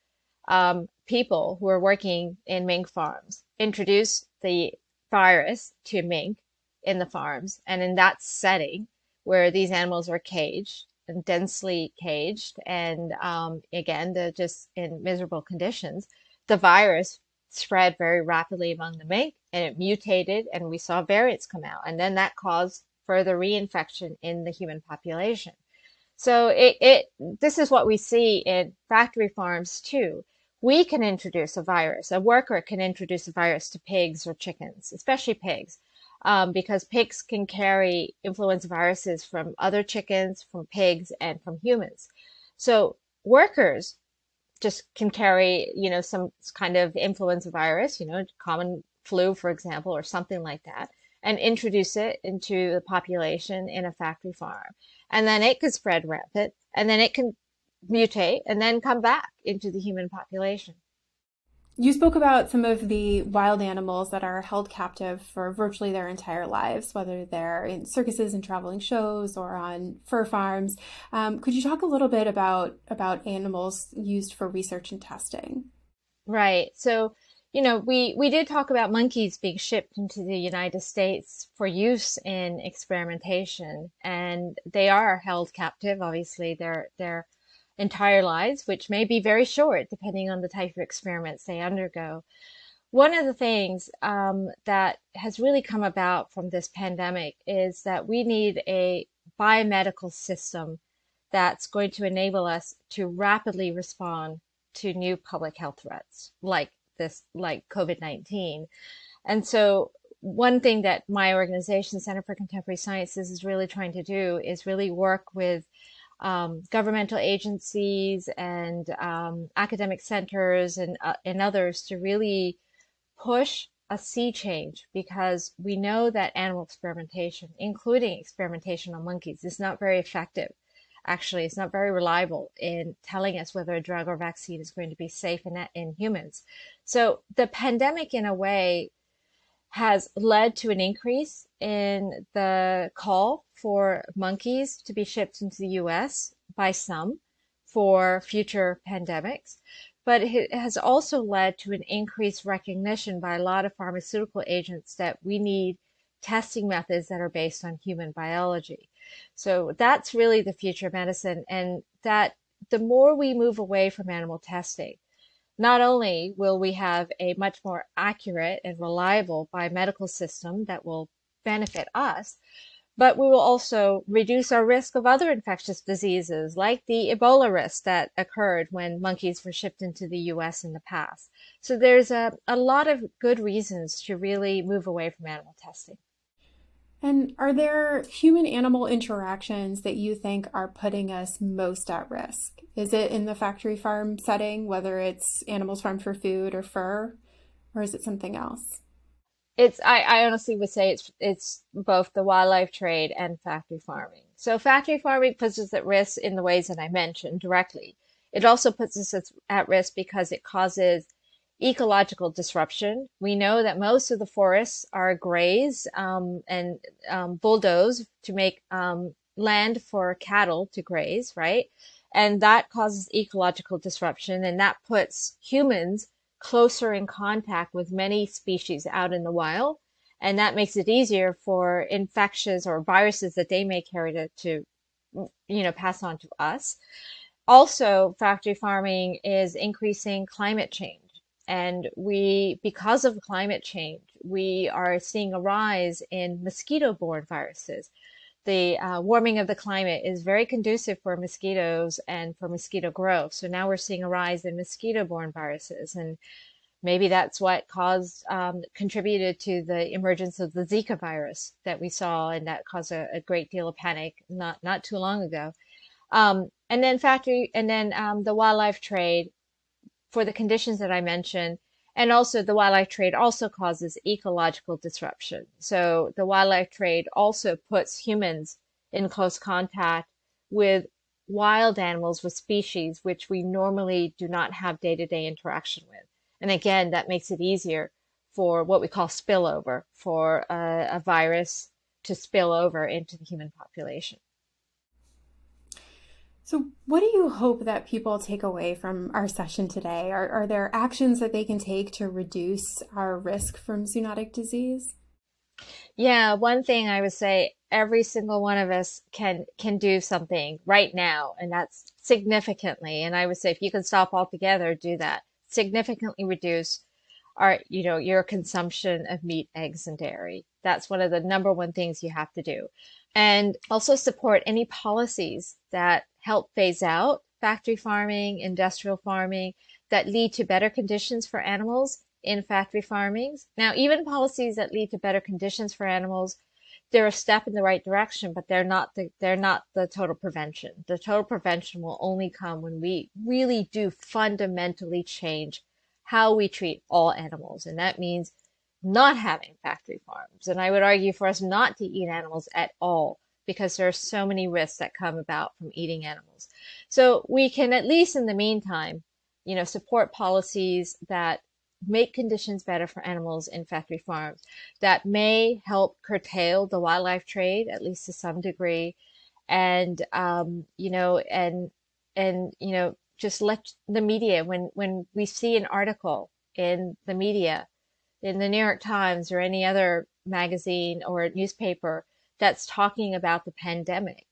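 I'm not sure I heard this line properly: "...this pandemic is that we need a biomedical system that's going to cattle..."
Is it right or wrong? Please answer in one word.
wrong.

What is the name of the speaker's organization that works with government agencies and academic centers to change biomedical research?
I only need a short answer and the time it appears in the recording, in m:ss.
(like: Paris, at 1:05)
Center for Contemporary Sciences, at 1:51.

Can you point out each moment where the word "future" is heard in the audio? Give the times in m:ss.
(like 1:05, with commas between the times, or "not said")
2:28, 2:40.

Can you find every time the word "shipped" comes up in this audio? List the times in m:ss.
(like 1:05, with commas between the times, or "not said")
1:19, 2:25, 2:59.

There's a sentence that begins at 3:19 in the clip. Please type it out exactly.
It's I, I honestly would say it's it's both the wildlife trade and factory farming.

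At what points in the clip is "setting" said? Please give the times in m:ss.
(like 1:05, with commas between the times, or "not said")
0:08, 3:14.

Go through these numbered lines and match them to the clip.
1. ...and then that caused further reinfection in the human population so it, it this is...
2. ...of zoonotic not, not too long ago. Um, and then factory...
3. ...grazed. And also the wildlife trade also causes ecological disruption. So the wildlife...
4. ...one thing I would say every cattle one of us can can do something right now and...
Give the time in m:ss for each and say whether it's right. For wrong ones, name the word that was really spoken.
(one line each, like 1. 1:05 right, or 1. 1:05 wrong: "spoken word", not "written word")
1. 0:21 right
2. 4:23 wrong: "panic", not "zoonotic"
3. 4:30 wrong: "mentioned", not "grazed"
4. 5:06 wrong: "single", not "cattle".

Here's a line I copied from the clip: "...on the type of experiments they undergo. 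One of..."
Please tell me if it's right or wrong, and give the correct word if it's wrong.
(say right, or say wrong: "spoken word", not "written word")
right.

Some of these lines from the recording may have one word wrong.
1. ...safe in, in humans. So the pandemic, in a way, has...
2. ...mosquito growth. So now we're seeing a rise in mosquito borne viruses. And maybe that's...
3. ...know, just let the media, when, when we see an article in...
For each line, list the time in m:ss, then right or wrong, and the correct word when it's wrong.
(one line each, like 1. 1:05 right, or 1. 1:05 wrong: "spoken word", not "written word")
1. 2:15 right
2. 4:12 right
3. 6:12 right.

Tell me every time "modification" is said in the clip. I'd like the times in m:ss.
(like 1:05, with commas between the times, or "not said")
not said.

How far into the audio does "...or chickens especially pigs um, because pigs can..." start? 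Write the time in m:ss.
0:34.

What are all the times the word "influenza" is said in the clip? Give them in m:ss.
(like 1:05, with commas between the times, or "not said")
0:38, 0:46.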